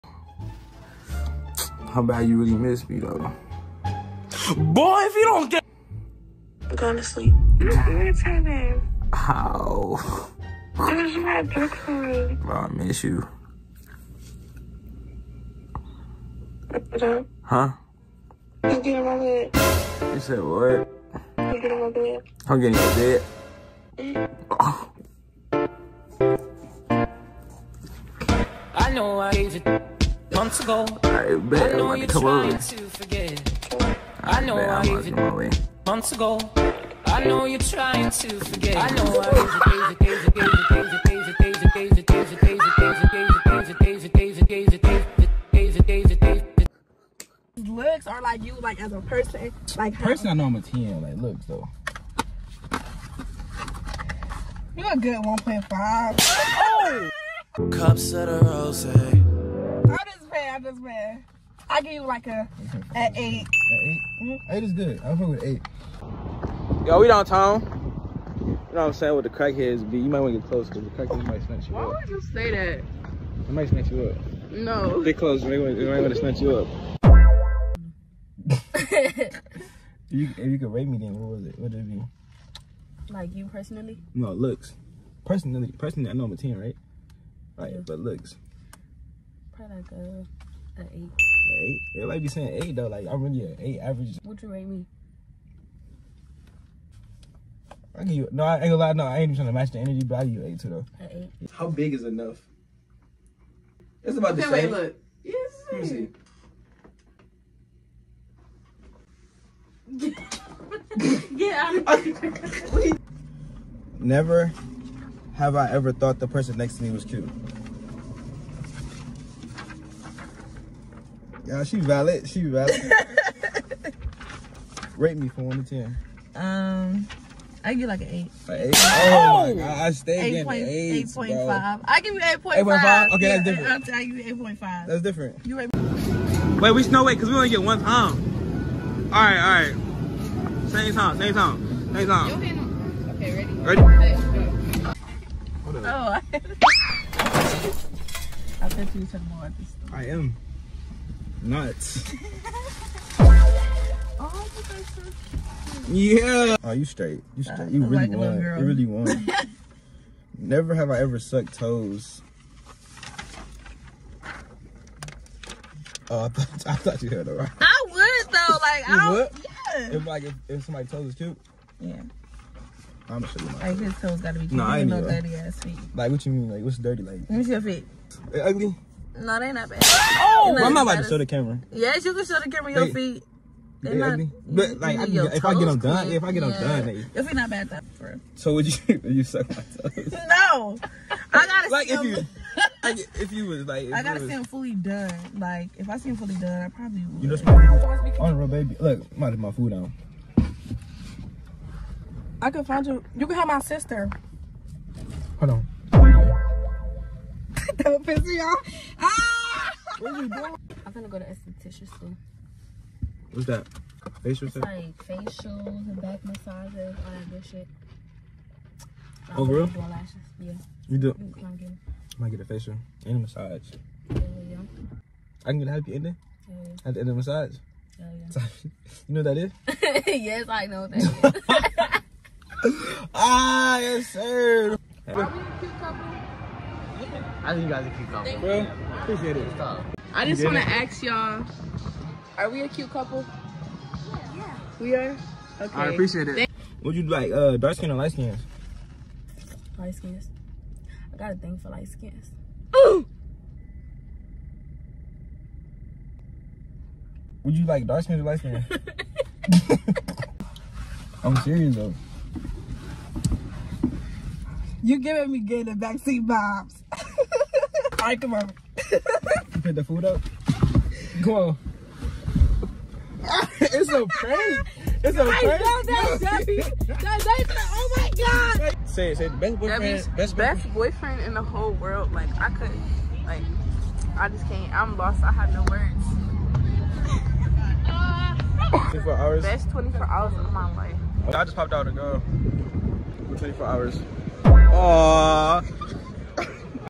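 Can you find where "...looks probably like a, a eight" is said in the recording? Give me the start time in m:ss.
1:28.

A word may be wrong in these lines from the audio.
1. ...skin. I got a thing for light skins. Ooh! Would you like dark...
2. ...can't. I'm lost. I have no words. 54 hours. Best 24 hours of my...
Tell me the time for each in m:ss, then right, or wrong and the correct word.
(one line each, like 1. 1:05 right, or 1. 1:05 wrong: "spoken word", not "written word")
1. 4:09 right
2. 4:44 wrong: "24", not "54".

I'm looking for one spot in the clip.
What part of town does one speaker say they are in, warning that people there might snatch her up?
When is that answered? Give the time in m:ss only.
1:07.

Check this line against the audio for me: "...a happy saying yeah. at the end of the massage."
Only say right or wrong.
wrong.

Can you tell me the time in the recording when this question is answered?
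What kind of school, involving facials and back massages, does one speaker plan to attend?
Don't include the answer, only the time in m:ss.
3:31.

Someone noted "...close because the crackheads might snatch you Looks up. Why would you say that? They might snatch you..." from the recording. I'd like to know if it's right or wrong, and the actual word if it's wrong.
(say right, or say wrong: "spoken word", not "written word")
wrong: "Why", not "Looks".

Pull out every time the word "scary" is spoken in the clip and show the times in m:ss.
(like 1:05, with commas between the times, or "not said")
not said.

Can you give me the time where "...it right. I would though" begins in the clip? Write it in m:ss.
2:47.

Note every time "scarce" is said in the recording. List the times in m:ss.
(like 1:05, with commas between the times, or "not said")
not said.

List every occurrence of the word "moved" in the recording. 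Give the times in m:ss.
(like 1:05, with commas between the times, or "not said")
not said.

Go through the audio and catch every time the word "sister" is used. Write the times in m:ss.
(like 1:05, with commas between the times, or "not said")
3:23.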